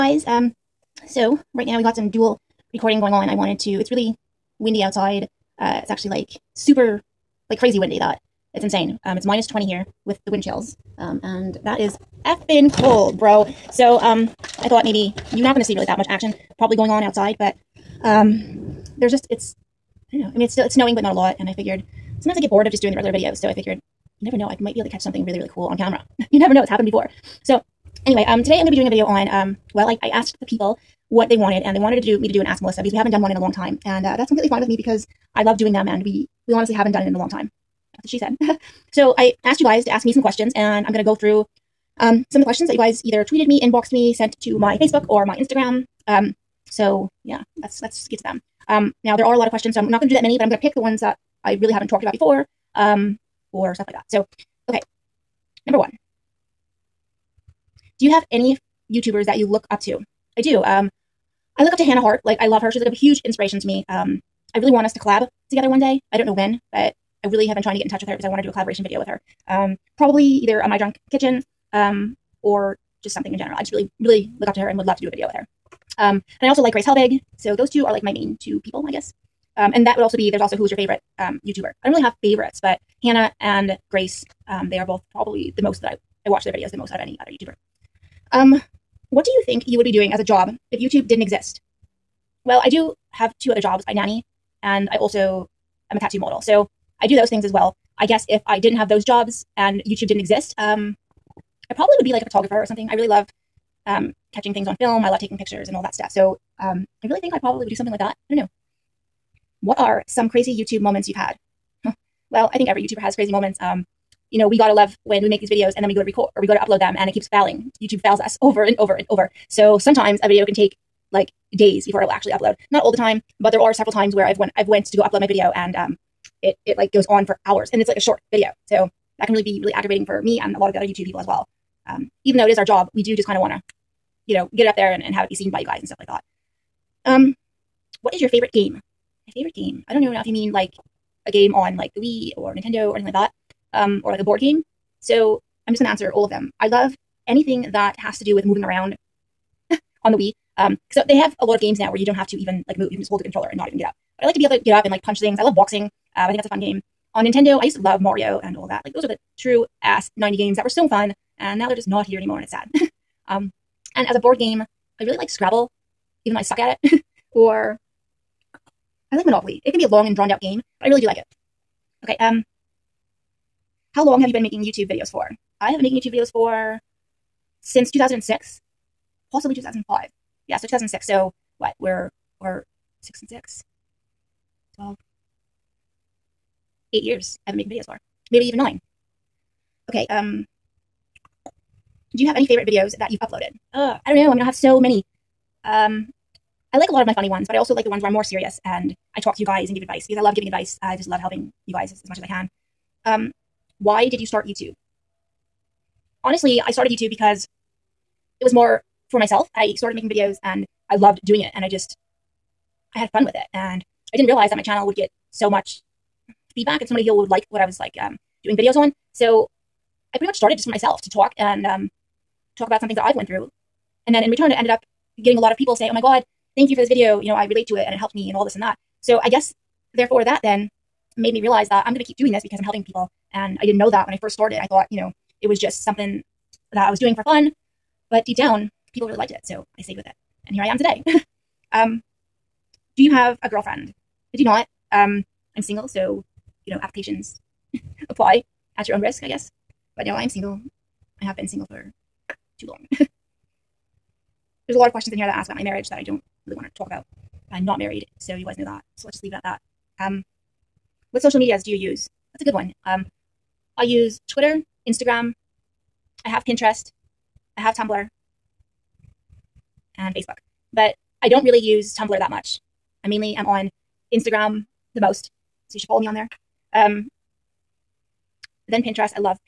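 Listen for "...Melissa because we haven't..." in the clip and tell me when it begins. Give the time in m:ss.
0:32.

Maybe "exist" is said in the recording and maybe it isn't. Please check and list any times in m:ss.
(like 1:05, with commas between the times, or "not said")
1:31, 1:40.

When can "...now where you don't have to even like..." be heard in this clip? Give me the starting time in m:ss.
2:31.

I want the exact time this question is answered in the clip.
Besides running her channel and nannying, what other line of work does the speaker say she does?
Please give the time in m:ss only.
1:35.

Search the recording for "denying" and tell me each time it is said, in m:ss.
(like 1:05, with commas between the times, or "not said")
not said.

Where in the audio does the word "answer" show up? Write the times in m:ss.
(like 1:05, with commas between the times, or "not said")
2:25.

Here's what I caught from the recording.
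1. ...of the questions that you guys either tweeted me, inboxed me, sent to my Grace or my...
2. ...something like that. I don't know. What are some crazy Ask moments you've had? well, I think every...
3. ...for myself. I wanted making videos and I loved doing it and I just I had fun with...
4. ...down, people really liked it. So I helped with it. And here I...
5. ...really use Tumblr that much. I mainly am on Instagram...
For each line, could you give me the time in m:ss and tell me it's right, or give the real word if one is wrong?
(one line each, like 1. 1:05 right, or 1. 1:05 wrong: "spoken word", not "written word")
1. 0:42 wrong: "Facebook", not "Grace"
2. 1:47 wrong: "YouTube", not "Ask"
3. 3:29 wrong: "started", not "wanted"
4. 3:58 wrong: "stayed", not "helped"
5. 4:31 right.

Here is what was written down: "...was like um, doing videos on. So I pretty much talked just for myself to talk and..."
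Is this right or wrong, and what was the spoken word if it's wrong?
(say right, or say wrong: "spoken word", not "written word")
wrong: "started", not "talked".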